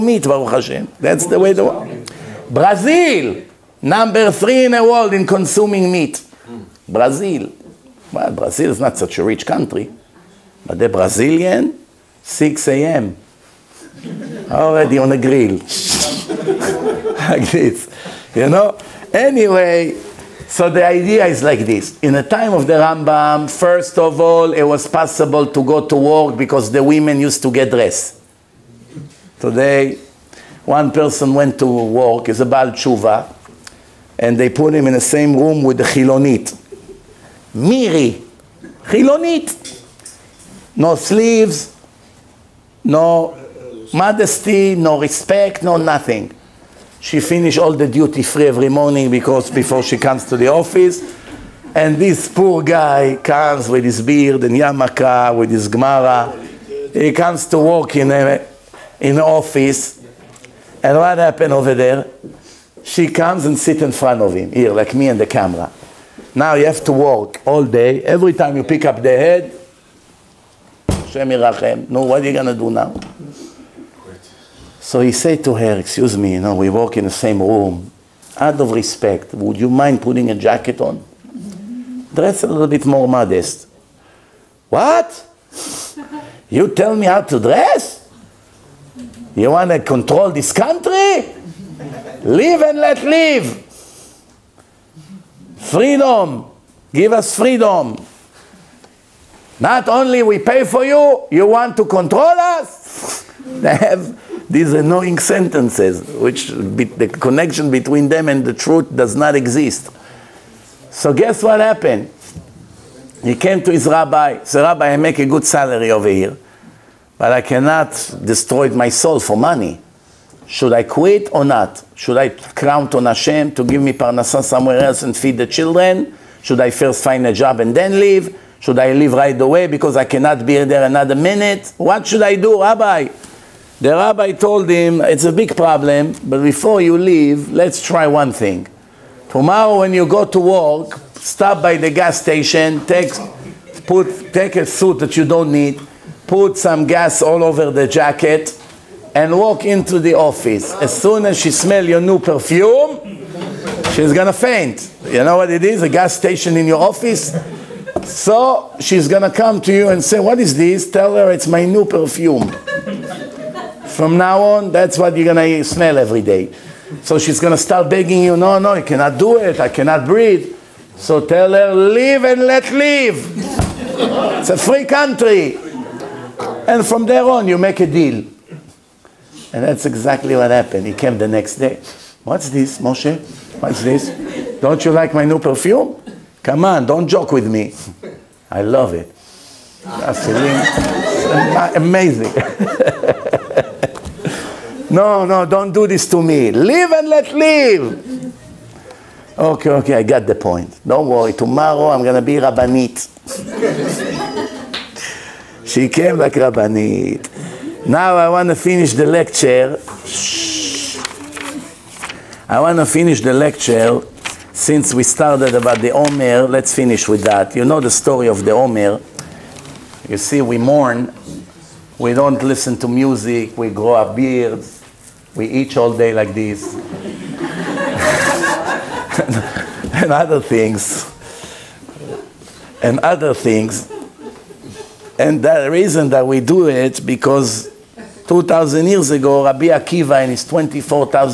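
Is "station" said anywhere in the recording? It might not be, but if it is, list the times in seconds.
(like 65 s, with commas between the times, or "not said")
142 s, 156 s.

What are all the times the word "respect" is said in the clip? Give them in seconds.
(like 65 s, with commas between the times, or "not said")
44 s, 78 s.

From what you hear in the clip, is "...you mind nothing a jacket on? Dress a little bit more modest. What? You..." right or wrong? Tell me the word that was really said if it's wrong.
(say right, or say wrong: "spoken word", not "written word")
wrong: "putting", not "nothing".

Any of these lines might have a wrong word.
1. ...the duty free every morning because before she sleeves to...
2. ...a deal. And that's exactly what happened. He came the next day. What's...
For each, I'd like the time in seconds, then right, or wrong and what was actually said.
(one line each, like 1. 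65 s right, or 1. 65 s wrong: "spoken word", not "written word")
1. 47 s wrong: "comes", not "sleeves"
2. 177 s right.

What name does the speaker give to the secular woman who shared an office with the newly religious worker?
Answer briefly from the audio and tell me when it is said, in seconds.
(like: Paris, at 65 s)
Miri, at 37 s.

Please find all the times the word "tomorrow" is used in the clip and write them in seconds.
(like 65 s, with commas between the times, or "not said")
139 s, 201 s.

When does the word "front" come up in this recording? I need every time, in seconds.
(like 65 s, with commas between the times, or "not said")
63 s.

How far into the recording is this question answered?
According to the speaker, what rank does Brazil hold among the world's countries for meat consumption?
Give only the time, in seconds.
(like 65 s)
3 s.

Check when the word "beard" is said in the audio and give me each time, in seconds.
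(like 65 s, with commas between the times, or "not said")
54 s, 224 s.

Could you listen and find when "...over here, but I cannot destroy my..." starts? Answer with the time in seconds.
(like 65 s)
115 s.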